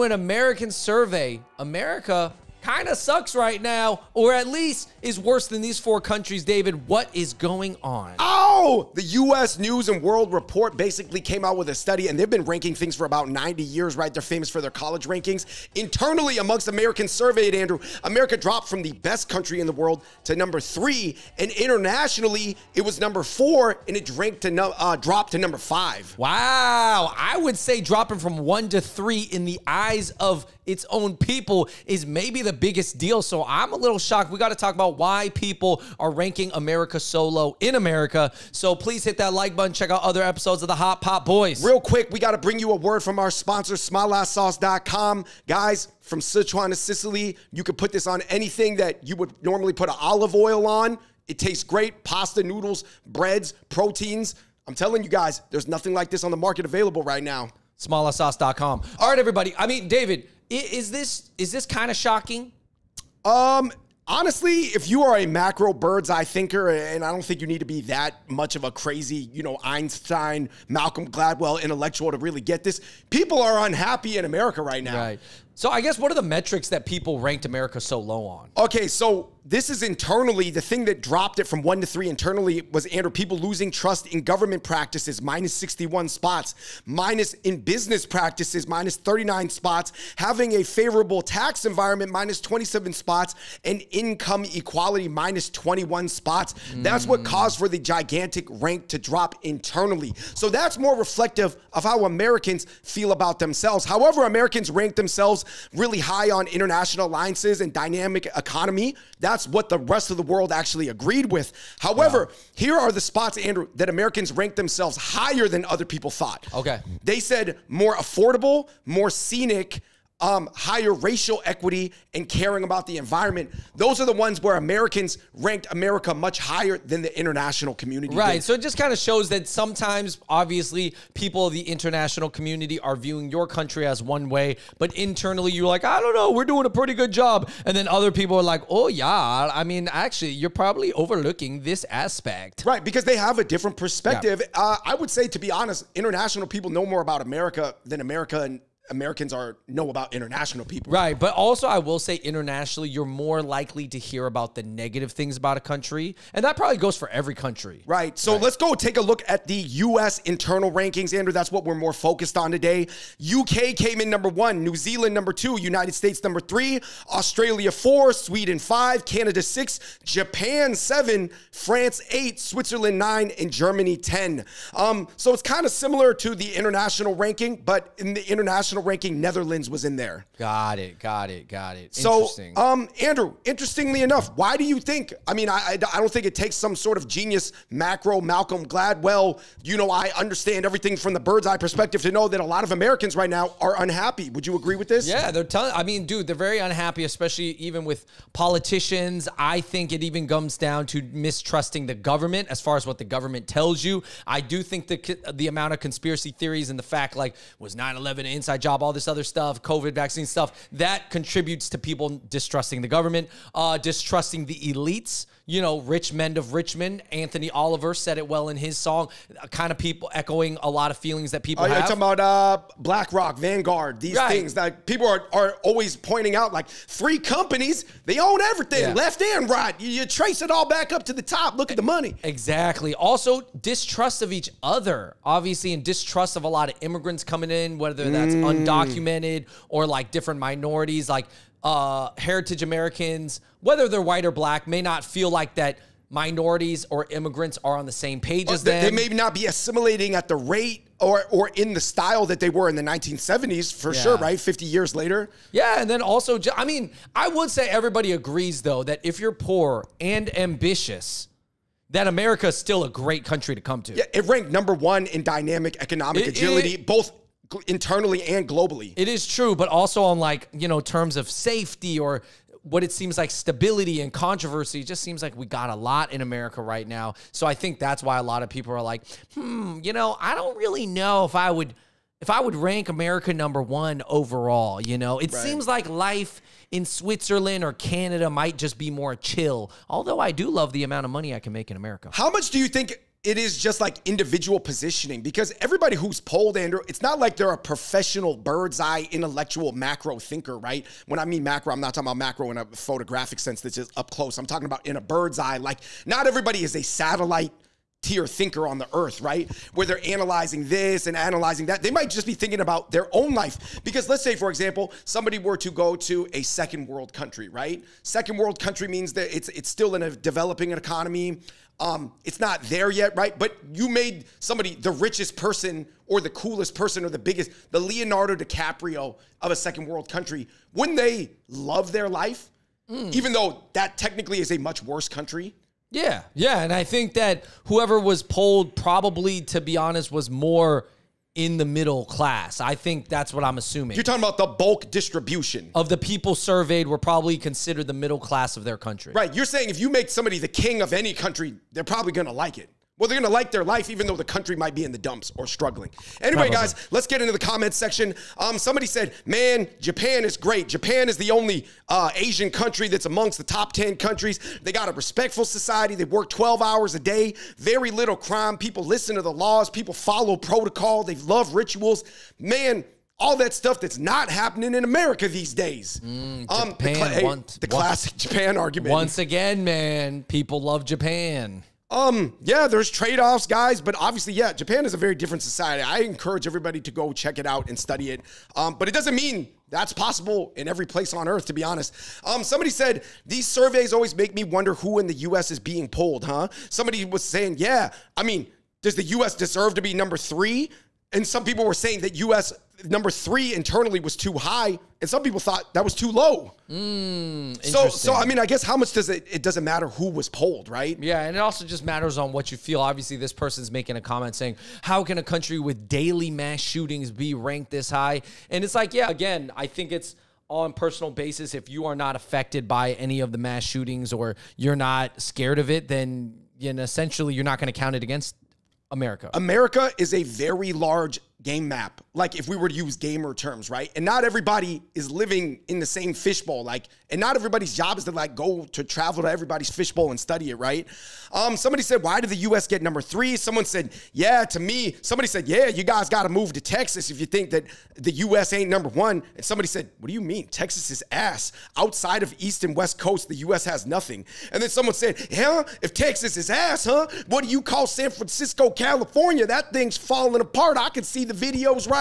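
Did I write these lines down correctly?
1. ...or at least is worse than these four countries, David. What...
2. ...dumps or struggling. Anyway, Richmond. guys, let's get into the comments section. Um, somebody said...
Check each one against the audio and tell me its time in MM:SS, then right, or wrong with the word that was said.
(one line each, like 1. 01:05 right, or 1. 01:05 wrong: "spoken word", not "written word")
1. 00:04 right
2. 05:54 wrong: "Probably", not "Richmond".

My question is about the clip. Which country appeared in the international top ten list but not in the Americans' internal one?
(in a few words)
Netherlands.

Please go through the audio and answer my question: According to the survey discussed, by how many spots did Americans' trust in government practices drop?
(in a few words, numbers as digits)
61.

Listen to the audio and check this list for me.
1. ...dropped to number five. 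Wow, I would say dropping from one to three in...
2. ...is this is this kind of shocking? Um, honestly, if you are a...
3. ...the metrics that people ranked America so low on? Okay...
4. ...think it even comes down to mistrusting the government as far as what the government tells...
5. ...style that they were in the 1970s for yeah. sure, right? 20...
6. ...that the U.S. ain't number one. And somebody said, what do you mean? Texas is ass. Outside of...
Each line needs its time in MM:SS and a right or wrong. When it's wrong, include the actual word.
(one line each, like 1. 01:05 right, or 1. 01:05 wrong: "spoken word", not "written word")
1. 00:24 right
2. 01:00 right
3. 01:16 right
4. 03:19 right
5. 04:11 wrong: "50", not "20"
6. 07:27 right.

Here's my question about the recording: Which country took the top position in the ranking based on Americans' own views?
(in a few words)
UK.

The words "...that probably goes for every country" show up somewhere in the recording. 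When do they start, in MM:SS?
02:36.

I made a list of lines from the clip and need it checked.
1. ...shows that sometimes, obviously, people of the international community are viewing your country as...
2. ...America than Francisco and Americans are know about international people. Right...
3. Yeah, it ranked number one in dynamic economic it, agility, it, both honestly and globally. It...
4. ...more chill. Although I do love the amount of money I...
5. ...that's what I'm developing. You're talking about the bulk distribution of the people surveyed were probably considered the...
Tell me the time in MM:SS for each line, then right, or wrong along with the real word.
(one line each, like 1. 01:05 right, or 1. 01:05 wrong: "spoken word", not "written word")
1. 02:08 right
2. 02:27 wrong: "America", not "Francisco"
3. 04:23 wrong: "internally", not "honestly"
4. 04:48 right
5. 05:43 wrong: "assuming", not "developing".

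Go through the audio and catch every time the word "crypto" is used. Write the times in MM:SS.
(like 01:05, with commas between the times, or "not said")
not said.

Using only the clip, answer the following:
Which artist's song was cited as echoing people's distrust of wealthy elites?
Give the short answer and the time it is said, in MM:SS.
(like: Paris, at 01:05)
Anthony Oliver, at 03:37.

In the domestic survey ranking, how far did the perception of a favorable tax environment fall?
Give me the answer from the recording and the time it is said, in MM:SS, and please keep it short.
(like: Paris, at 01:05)
27 spots, at 01:32.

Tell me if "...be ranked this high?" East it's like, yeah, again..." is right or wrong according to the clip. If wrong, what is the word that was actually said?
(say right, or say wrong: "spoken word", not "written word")
wrong: "And", not "East".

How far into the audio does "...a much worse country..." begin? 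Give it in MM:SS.
05:34.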